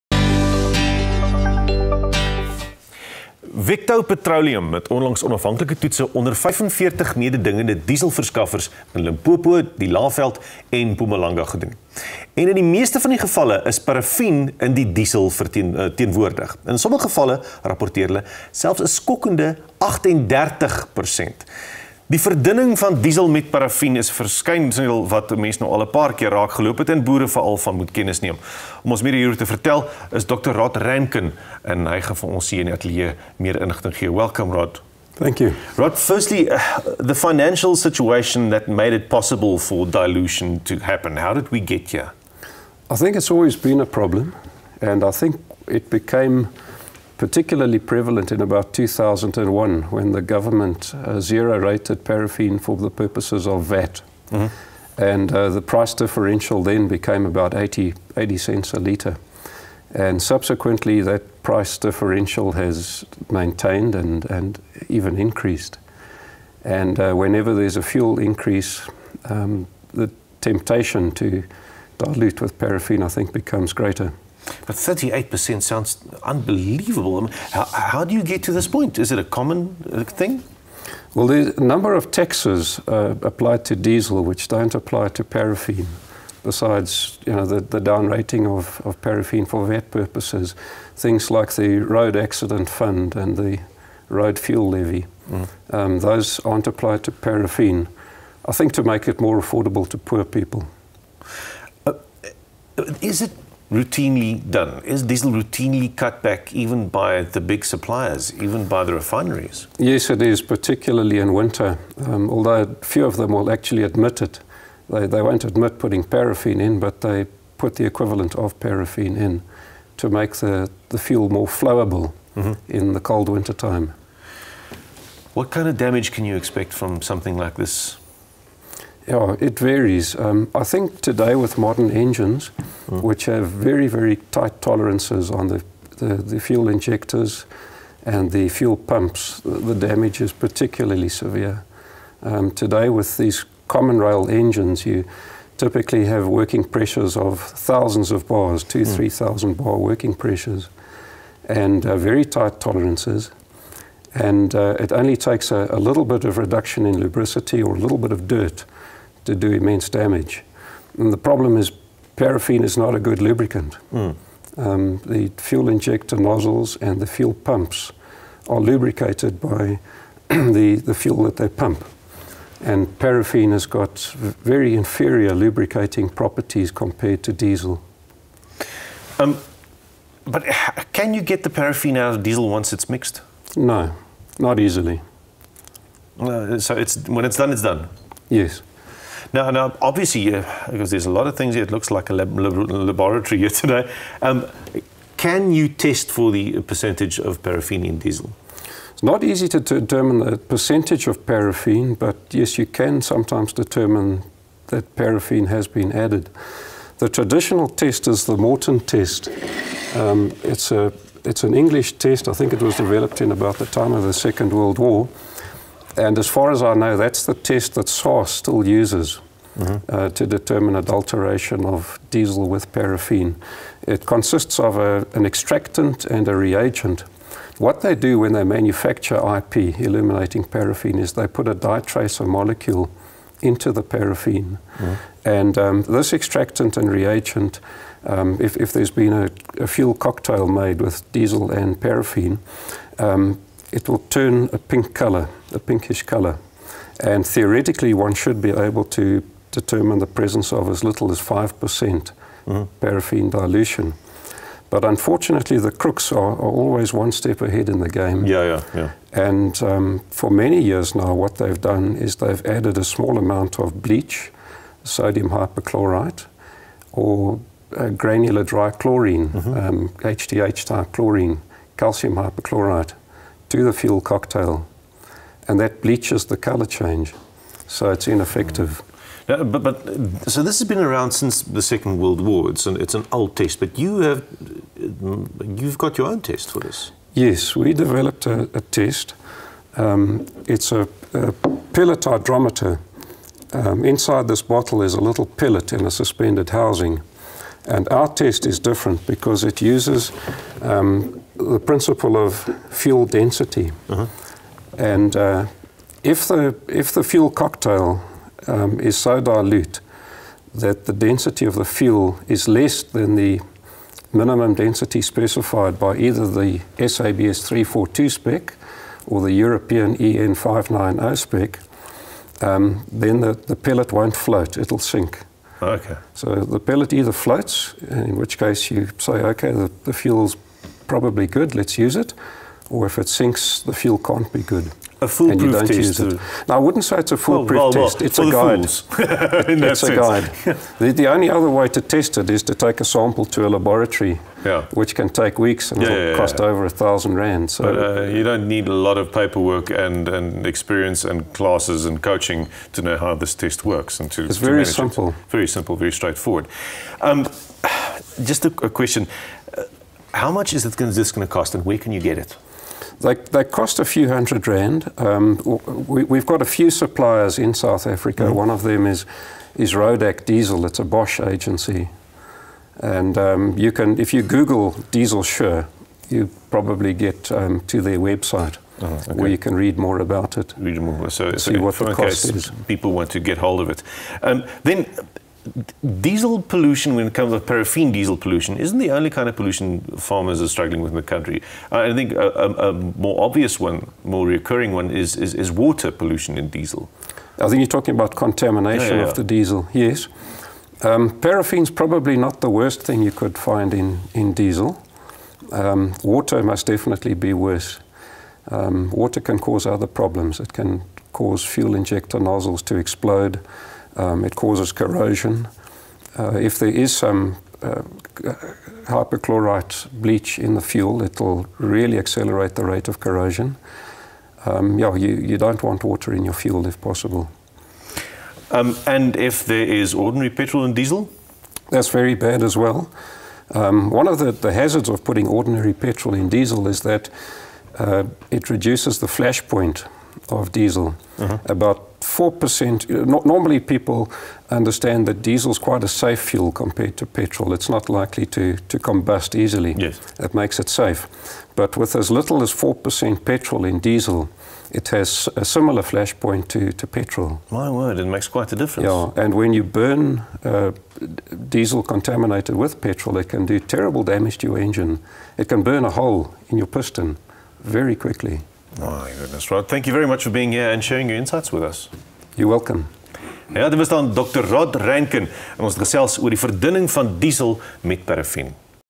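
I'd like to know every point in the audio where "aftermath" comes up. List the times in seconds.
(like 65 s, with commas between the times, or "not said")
not said.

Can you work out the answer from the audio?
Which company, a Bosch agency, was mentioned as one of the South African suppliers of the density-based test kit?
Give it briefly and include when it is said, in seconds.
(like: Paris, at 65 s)
Rodak Diesel, at 369 s.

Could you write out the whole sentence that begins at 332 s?
Or if it sinks, the fuel can't be good.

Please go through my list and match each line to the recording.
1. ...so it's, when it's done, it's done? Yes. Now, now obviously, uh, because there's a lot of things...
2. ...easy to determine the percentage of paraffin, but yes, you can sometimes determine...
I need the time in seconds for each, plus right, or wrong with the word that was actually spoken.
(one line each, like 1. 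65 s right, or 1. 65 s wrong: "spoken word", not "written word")
1. 186 s right
2. 199 s right.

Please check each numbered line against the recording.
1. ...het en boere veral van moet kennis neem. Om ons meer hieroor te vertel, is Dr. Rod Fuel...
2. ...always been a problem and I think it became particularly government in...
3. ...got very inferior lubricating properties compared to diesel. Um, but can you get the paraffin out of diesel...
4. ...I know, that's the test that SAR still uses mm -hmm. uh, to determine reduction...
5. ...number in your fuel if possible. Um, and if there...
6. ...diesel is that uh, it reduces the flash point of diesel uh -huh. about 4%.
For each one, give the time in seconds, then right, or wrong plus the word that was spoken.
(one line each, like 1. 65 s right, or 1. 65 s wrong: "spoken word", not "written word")
1. 26 s wrong: "Ranken", not "Fuel"
2. 43 s wrong: "prevalent", not "government"
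3. 173 s right
4. 216 s wrong: "adulteration", not "reduction"
5. 425 s wrong: "water", not "number"
6. 436 s right.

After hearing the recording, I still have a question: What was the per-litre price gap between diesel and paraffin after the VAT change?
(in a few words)
80 cents.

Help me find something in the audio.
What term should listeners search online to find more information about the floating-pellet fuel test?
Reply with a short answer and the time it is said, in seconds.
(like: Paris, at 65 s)
Diesel Sure, at 374 s.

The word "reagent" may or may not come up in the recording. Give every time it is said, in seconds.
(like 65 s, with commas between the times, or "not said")
226 s, 236 s.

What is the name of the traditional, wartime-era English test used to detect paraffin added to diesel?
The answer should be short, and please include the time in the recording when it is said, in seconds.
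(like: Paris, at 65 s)
Morton test, at 208 s.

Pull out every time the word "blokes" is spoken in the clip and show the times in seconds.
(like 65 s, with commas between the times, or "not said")
not said.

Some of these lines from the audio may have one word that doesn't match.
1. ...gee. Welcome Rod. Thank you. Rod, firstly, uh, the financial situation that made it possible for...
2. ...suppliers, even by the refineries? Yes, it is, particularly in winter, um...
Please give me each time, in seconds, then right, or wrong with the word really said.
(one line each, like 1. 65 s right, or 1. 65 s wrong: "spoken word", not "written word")
1. 33 s right
2. 107 s right.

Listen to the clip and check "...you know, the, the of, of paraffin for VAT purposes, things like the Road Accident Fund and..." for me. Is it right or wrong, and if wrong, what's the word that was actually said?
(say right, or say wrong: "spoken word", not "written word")
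right.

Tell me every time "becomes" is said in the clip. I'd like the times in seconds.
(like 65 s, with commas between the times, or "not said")
73 s.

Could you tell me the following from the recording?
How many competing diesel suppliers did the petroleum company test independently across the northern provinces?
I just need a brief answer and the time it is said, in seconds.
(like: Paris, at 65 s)
45, at 6 s.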